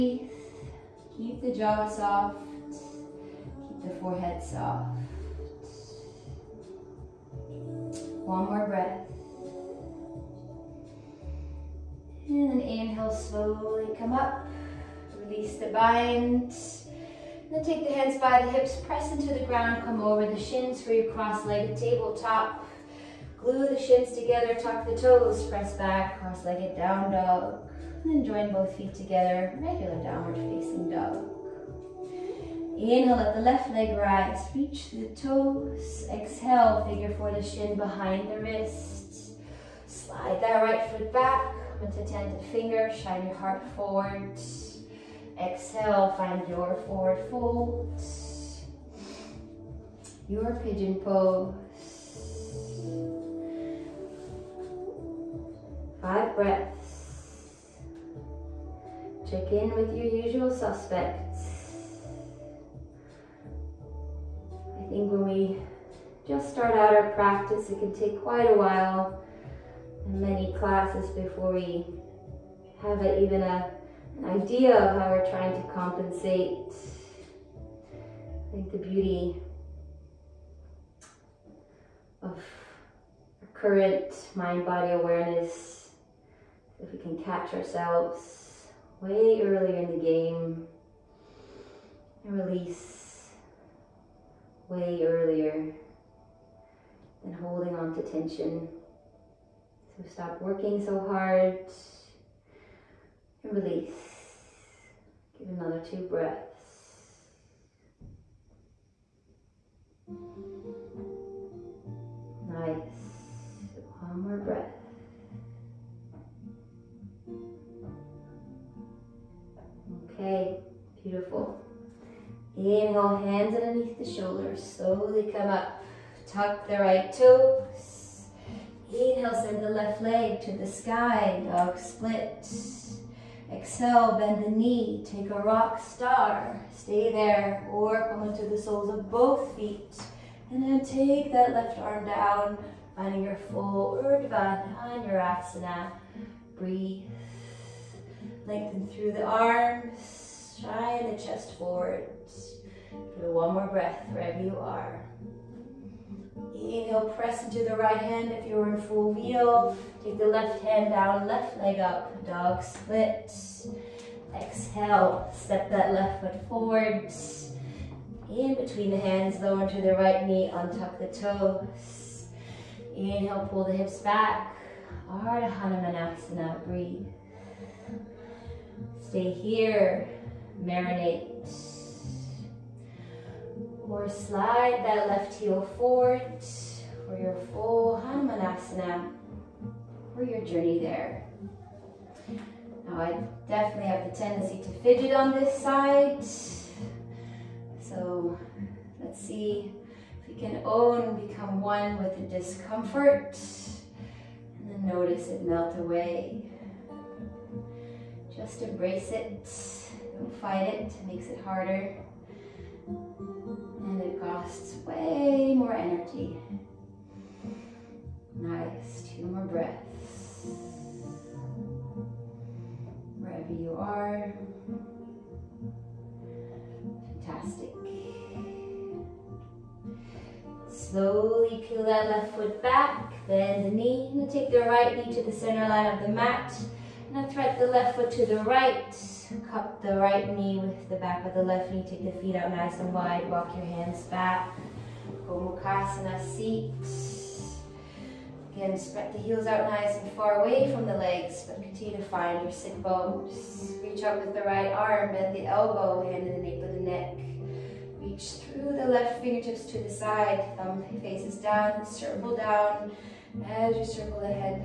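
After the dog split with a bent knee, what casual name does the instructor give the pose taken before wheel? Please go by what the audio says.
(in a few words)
Rock star.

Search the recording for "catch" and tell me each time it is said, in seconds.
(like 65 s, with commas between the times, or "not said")
87 s.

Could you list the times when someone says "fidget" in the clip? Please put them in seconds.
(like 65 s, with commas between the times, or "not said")
194 s.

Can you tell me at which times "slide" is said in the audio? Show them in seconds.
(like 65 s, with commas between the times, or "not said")
39 s, 184 s.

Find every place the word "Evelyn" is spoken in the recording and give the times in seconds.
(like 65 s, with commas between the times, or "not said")
not said.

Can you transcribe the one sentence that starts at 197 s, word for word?
So let's see if we can own, become one with the discomfort.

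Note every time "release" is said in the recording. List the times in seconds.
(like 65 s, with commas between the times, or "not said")
15 s, 92 s, 103 s.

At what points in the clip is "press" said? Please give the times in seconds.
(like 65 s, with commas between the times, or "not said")
18 s, 25 s, 157 s.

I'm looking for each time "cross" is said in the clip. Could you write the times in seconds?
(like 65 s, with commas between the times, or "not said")
21 s, 26 s.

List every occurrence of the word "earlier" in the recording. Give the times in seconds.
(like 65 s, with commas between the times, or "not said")
89 s, 95 s.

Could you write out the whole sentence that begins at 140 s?
And then take that left arm down, finding your full Urdhva Dhanurasana.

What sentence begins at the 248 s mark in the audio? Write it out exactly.
Again, spread the heels out nice and far away from the legs, but continue to find your sit bones.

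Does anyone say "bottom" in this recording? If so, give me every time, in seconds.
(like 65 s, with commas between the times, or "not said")
not said.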